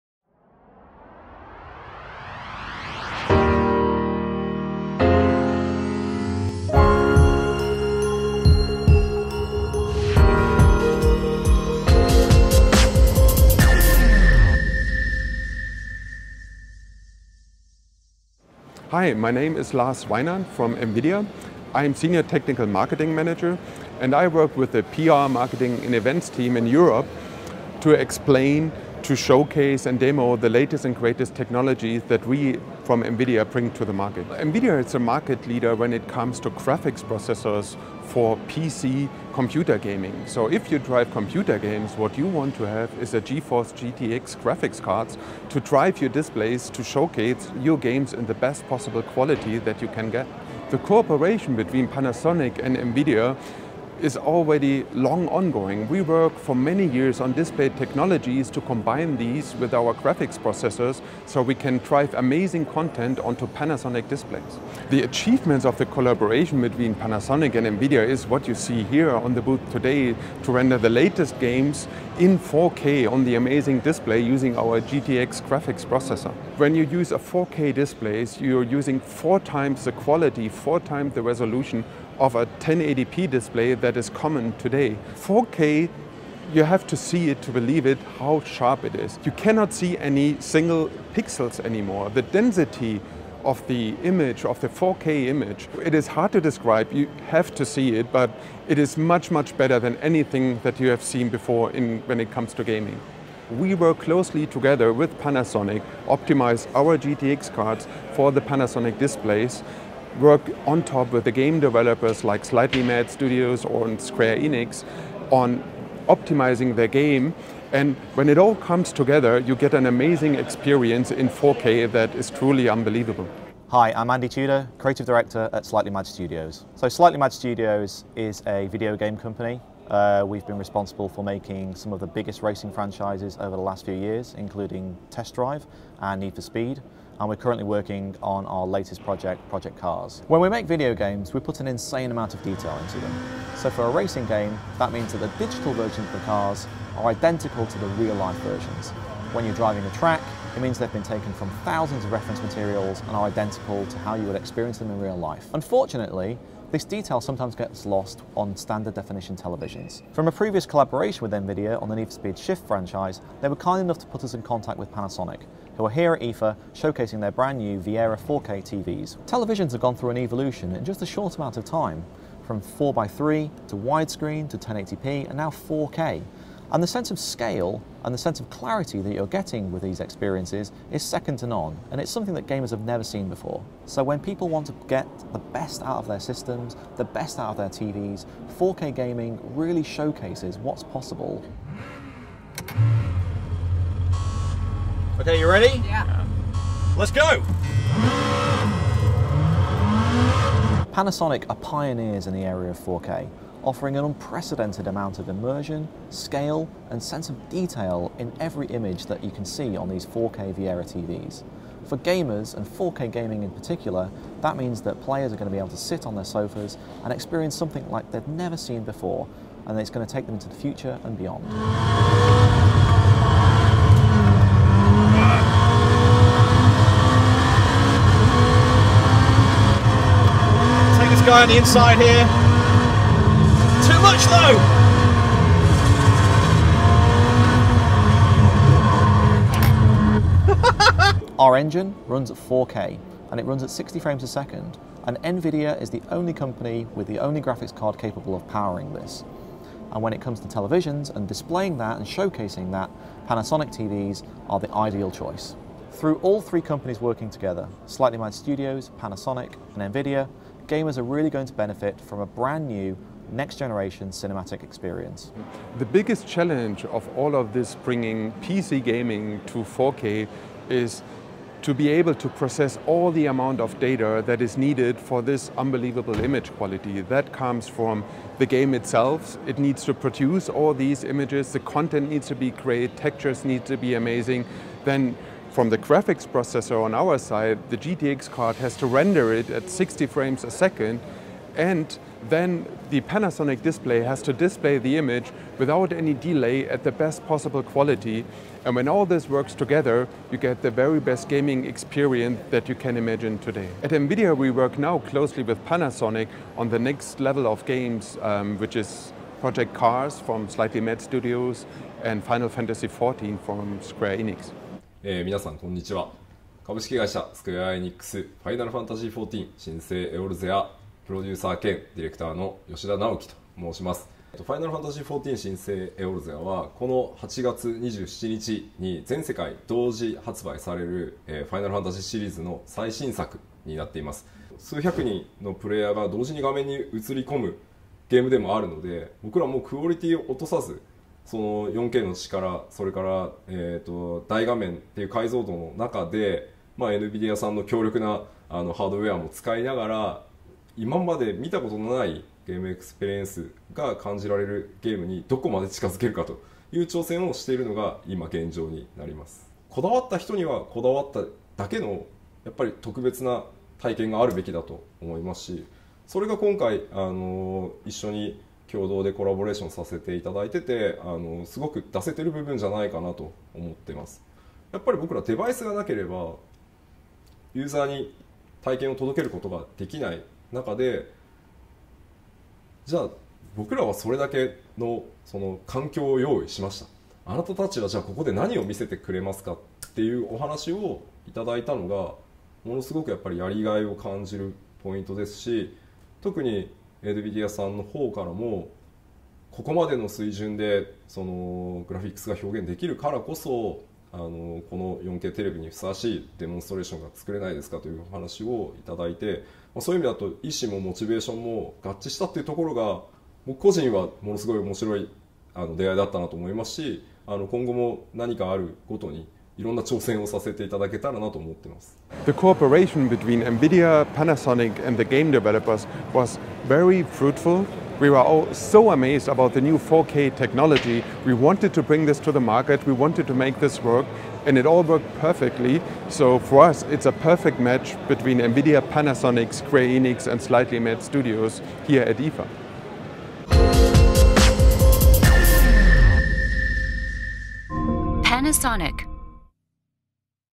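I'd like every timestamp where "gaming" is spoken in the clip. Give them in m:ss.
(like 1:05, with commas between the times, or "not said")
0:39, 1:42, 3:08, 3:33, 4:28, 5:01.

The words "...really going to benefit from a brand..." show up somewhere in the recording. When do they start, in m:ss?
4:21.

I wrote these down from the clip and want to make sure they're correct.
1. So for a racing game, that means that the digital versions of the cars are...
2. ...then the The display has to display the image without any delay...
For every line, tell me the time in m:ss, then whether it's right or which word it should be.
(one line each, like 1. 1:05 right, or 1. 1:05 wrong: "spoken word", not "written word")
1. 2:23 right
2. 4:52 wrong: "Panasonic", not "The".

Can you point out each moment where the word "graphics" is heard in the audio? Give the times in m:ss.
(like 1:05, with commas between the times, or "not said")
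0:36, 0:44, 0:59, 1:15, 4:07, 4:45.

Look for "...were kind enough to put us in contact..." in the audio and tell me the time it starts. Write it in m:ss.
2:43.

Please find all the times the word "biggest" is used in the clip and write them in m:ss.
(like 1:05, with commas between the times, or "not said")
2:12, 4:25.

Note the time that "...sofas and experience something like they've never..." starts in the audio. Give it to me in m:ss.
3:36.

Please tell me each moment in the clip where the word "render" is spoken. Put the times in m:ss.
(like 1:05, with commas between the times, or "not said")
1:10, 4:48.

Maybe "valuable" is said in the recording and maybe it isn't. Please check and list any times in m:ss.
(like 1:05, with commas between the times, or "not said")
not said.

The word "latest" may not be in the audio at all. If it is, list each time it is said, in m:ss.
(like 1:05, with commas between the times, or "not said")
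0:30, 1:10, 2:18.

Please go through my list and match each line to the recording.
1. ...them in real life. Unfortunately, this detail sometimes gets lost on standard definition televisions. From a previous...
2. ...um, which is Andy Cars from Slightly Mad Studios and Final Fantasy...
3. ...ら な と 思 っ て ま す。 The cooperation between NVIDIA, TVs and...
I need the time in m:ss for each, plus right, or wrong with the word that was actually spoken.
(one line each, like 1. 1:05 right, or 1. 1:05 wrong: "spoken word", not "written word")
1. 2:34 right
2. 5:08 wrong: "Project", not "Andy"
3. 7:01 wrong: "Panasonic", not "TVs".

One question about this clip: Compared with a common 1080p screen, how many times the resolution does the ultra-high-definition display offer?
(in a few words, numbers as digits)
4 times.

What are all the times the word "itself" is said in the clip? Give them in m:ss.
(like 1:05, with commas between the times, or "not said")
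4:38.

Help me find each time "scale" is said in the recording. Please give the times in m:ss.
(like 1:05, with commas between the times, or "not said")
2:57, 3:26.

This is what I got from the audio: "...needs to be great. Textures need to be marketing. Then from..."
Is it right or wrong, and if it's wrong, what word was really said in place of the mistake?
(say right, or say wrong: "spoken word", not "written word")
wrong: "amazing", not "marketing".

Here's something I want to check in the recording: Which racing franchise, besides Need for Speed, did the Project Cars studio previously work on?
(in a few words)
Test Drive.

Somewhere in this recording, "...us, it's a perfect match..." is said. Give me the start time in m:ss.
7:16.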